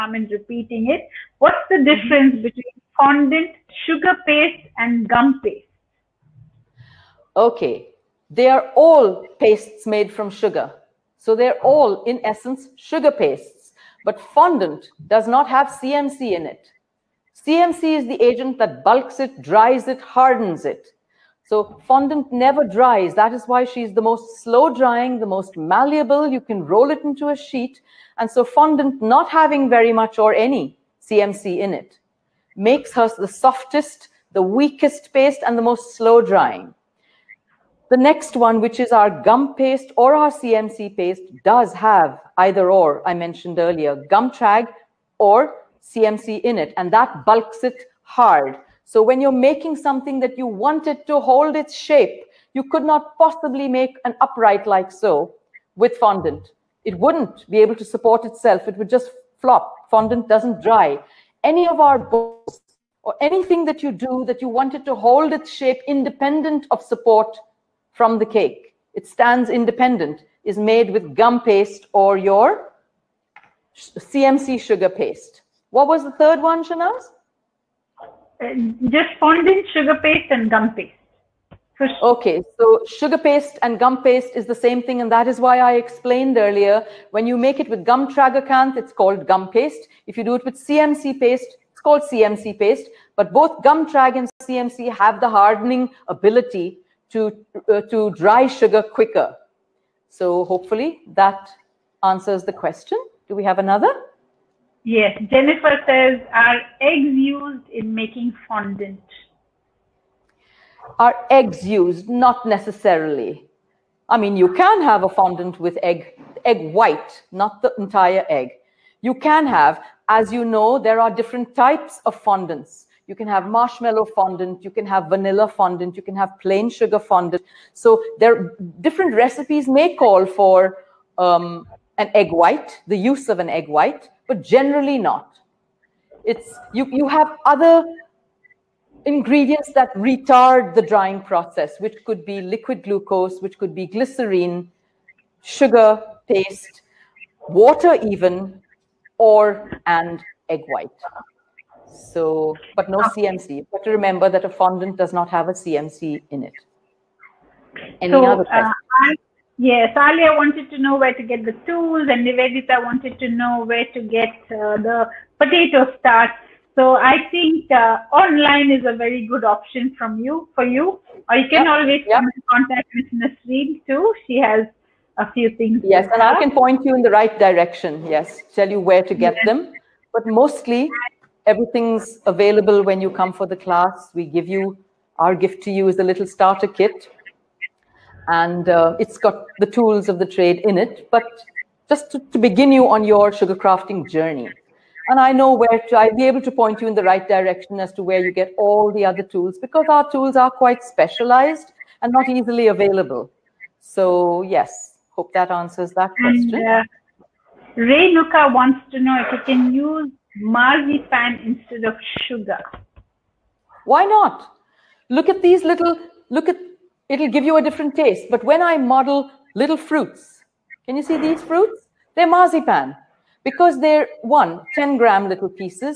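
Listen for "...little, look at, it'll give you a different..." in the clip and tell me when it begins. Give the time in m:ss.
3:35.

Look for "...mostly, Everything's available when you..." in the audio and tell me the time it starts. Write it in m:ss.
3:00.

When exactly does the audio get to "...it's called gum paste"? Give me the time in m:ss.
1:28.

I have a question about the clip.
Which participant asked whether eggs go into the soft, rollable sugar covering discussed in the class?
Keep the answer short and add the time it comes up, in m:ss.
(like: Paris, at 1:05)
Jennifer, at 1:45.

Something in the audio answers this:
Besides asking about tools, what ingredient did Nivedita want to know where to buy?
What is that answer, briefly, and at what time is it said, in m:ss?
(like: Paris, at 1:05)
potato starch, at 2:45.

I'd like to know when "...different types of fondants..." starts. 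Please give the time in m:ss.
2:01.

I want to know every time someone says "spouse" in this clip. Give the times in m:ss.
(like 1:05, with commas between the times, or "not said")
not said.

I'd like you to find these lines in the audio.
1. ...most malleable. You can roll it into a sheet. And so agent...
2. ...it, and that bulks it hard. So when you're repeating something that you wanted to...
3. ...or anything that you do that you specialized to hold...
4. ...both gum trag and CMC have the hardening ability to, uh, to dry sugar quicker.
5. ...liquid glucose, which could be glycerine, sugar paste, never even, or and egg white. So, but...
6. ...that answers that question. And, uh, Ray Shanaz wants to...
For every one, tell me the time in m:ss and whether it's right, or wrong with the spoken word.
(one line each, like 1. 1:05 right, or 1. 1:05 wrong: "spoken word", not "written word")
1. 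0:25 wrong: "fondant", not "agent"
2. 0:46 wrong: "making", not "repeating"
3. 1:03 wrong: "wanted", not "specialized"
4. 1:33 right
5. 2:22 wrong: "water", not "never"
6. 3:25 wrong: "Nuka", not "Shanaz".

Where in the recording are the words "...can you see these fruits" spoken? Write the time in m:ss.
3:40.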